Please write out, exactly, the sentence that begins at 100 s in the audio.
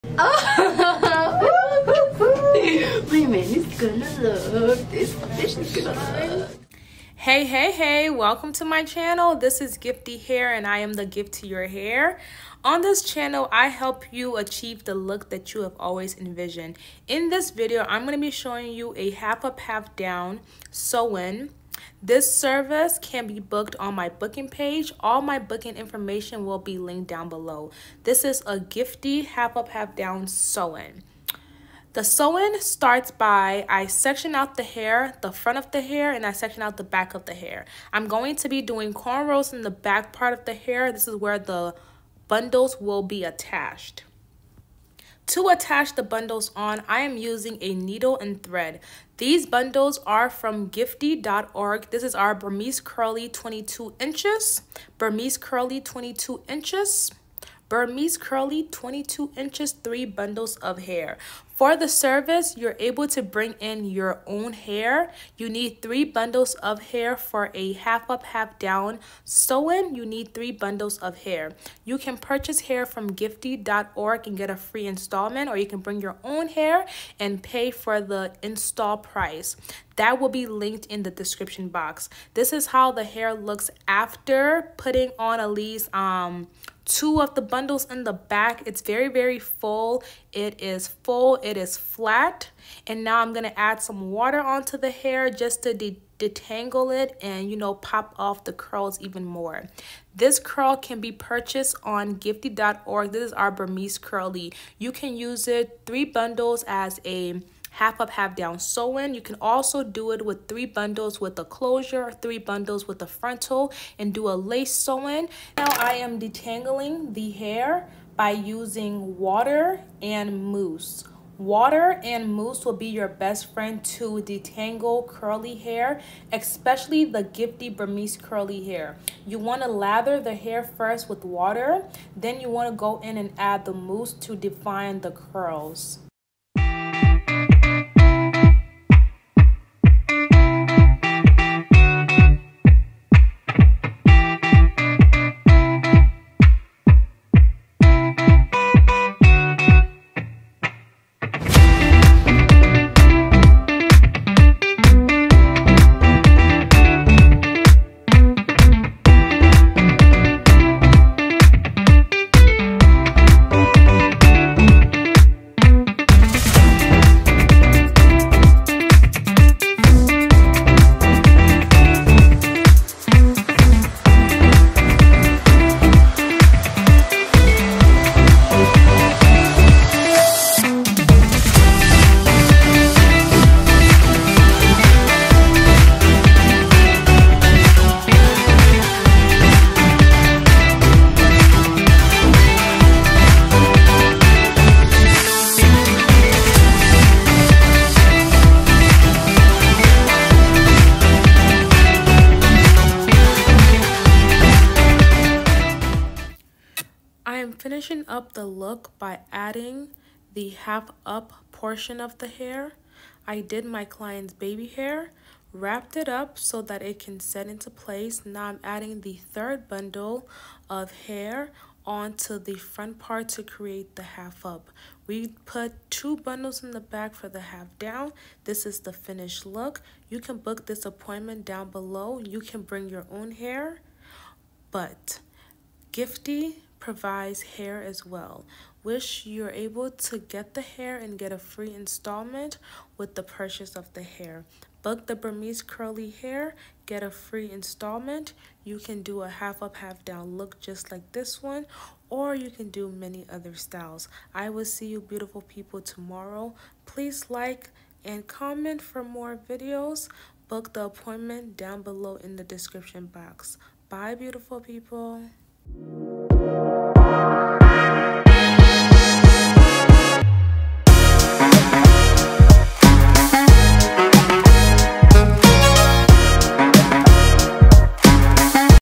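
This curl can be purchased on giifti.org.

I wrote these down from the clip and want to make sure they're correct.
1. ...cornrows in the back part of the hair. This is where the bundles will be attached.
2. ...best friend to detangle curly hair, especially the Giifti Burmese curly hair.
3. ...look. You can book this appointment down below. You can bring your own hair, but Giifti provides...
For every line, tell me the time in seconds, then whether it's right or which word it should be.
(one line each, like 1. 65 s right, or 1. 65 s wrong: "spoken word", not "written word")
1. 38 s right
2. 123 s right
3. 229 s right.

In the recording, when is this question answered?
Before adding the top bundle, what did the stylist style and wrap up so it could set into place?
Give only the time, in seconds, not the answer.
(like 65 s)
214 s.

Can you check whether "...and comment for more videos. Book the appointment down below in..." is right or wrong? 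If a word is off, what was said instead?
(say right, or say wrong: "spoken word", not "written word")
right.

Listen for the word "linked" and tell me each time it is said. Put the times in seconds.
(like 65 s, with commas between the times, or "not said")
26 s, 80 s.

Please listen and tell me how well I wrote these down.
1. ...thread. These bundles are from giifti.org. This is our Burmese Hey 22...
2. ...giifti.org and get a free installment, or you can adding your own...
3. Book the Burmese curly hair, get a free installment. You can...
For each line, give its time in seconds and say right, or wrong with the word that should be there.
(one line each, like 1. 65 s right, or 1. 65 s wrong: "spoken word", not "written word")
1. 48 s wrong: "Curly", not "Hey"
2. 73 s wrong: "bring", not "adding"
3. 244 s right.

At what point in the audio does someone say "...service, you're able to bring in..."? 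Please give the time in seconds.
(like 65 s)
61 s.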